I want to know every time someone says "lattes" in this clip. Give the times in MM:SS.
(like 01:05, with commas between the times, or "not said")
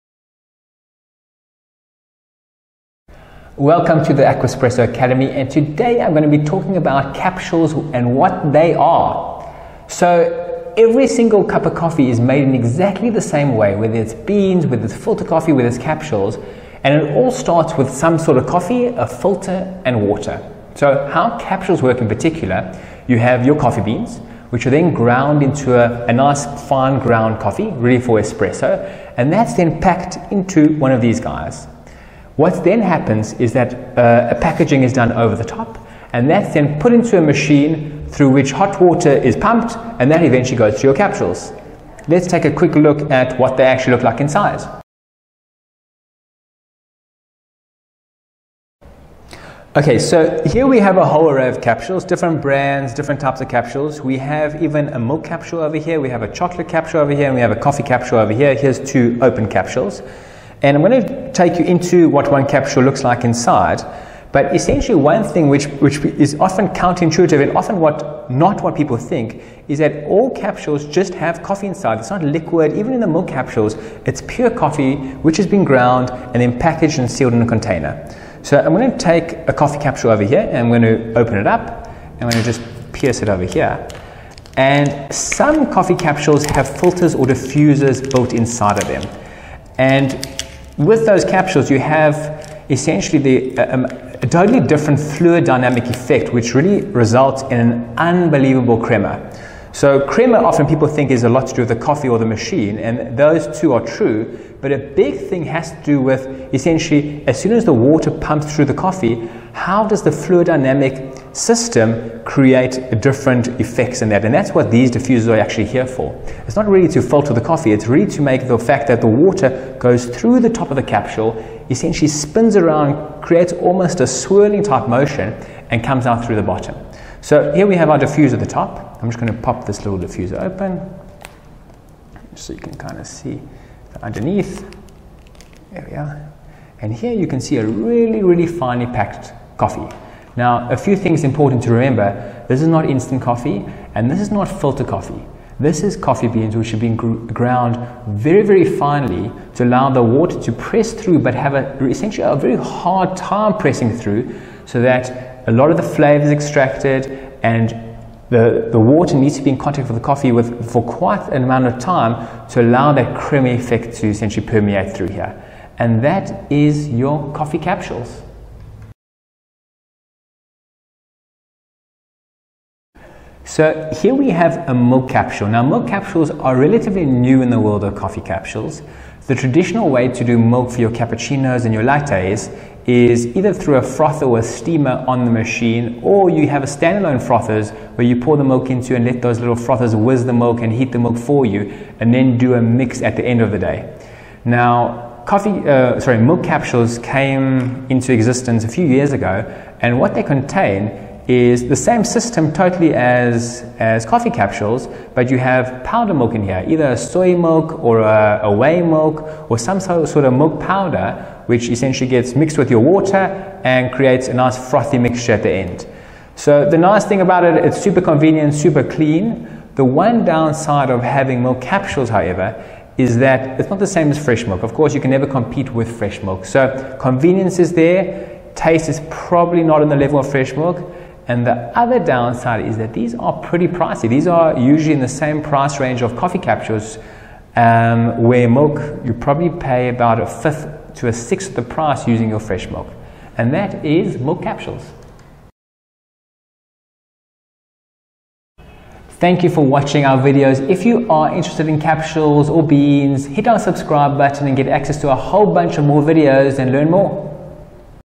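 03:01.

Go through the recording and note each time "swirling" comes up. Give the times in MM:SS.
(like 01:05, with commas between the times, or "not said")
02:04.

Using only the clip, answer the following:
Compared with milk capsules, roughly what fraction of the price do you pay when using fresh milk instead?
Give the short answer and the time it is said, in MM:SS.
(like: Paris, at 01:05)
A fifth to a sixth, at 04:00.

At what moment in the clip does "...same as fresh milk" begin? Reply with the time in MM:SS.
03:43.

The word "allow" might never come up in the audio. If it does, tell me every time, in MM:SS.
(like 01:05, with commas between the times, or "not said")
02:29, 02:42.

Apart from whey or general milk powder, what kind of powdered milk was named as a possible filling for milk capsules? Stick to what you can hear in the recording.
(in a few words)
Soy milk.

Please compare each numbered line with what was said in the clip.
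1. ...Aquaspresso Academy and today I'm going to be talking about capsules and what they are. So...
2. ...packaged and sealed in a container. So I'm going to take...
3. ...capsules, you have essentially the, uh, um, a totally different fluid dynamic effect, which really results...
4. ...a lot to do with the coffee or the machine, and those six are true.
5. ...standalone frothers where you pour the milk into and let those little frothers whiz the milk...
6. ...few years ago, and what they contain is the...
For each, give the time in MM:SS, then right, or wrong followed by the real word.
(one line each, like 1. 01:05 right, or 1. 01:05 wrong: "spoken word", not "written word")
1. 00:04 right
2. 01:16 right
3. 01:31 right
4. 01:41 wrong: "two", not "six"
5. 03:06 right
6. 03:18 right.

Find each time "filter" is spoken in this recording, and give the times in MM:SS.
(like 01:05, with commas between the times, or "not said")
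00:14, 00:19, 01:26, 01:57, 02:24.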